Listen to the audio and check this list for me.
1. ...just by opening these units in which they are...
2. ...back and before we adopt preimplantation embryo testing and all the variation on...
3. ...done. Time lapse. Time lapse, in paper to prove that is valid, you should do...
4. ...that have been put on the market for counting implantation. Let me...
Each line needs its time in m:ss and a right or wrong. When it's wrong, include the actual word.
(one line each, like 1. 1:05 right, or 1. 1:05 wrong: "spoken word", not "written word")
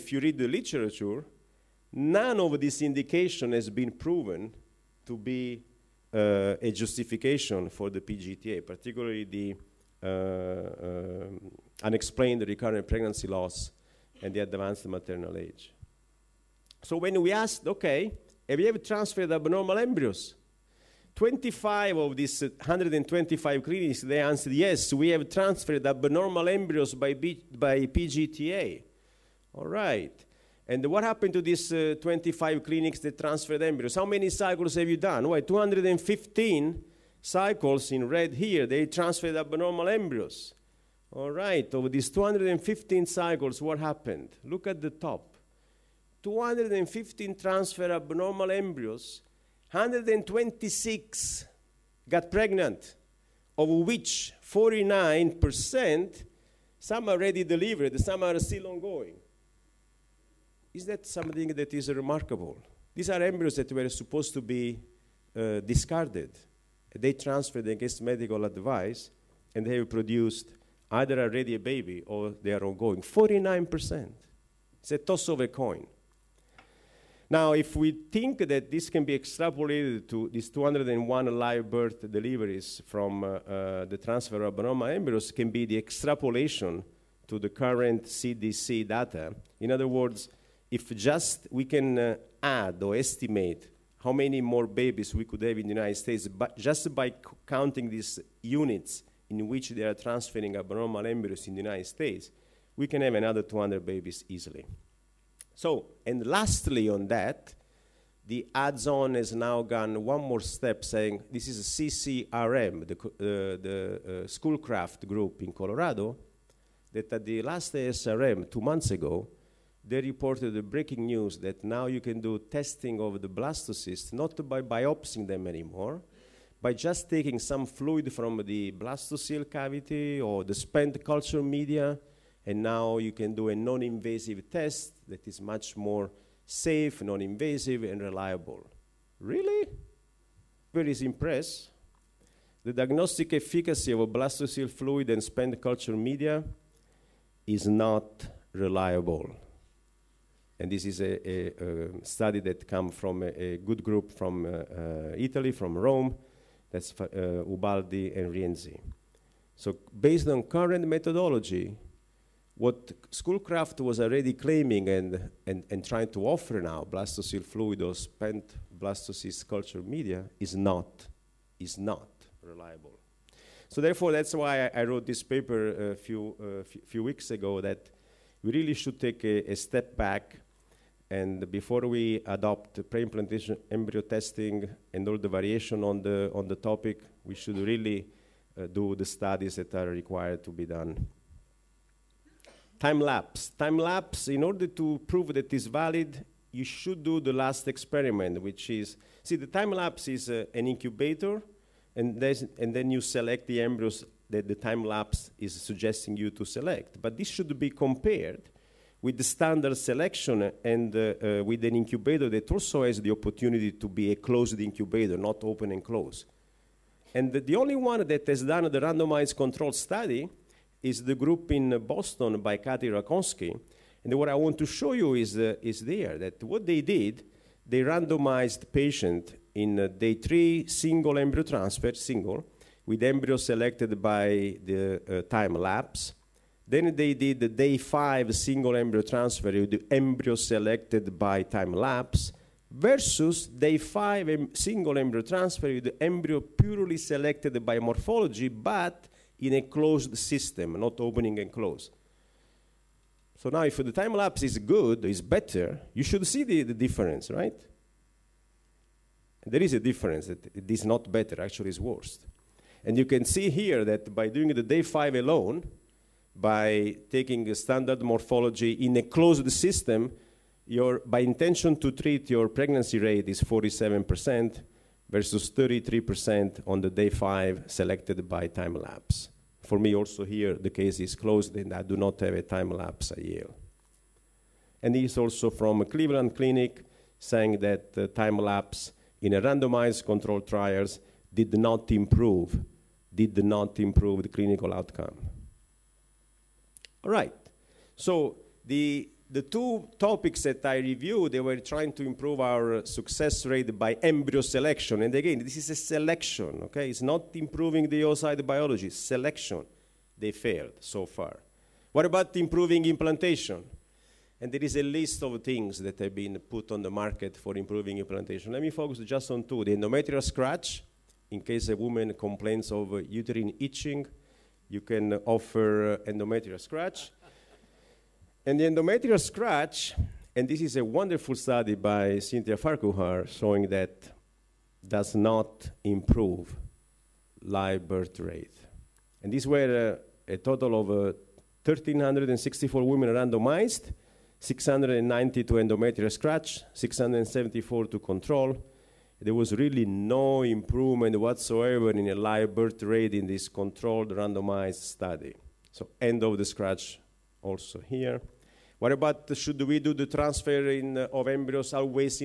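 1. 1:36 wrong: "counting", not "opening"
2. 2:59 right
3. 3:10 wrong: "order", not "paper"
4. 5:15 wrong: "improving", not "counting".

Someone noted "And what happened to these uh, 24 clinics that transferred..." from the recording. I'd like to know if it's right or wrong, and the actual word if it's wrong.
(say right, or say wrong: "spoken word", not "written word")
wrong: "25", not "24".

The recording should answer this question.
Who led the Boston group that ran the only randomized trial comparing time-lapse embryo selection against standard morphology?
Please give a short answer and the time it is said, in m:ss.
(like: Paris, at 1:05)
Katy Racowsky, at 3:42.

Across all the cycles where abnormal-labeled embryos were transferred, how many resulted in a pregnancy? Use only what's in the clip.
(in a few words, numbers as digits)
126.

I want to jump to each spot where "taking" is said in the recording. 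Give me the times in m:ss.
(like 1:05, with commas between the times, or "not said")
2:07, 4:27.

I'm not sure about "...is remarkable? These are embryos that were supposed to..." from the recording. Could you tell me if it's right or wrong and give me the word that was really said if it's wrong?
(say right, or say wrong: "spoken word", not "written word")
right.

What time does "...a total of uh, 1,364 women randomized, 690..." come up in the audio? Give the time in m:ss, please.
5:40.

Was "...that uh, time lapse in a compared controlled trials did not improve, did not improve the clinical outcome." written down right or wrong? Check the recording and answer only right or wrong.
wrong.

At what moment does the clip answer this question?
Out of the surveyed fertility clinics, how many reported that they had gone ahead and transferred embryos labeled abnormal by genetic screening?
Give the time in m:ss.
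0:21.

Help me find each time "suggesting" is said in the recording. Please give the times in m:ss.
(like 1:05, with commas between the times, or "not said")
3:25.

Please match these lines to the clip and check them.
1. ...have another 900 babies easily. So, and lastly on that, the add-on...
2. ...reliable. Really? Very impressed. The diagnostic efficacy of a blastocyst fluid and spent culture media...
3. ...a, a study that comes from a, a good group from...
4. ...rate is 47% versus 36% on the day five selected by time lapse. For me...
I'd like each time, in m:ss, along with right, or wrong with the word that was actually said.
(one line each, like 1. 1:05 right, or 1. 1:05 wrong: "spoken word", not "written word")
1. 1:43 wrong: "200", not "900"
2. 2:18 right
3. 2:31 right
4. 4:32 wrong: "33", not "36".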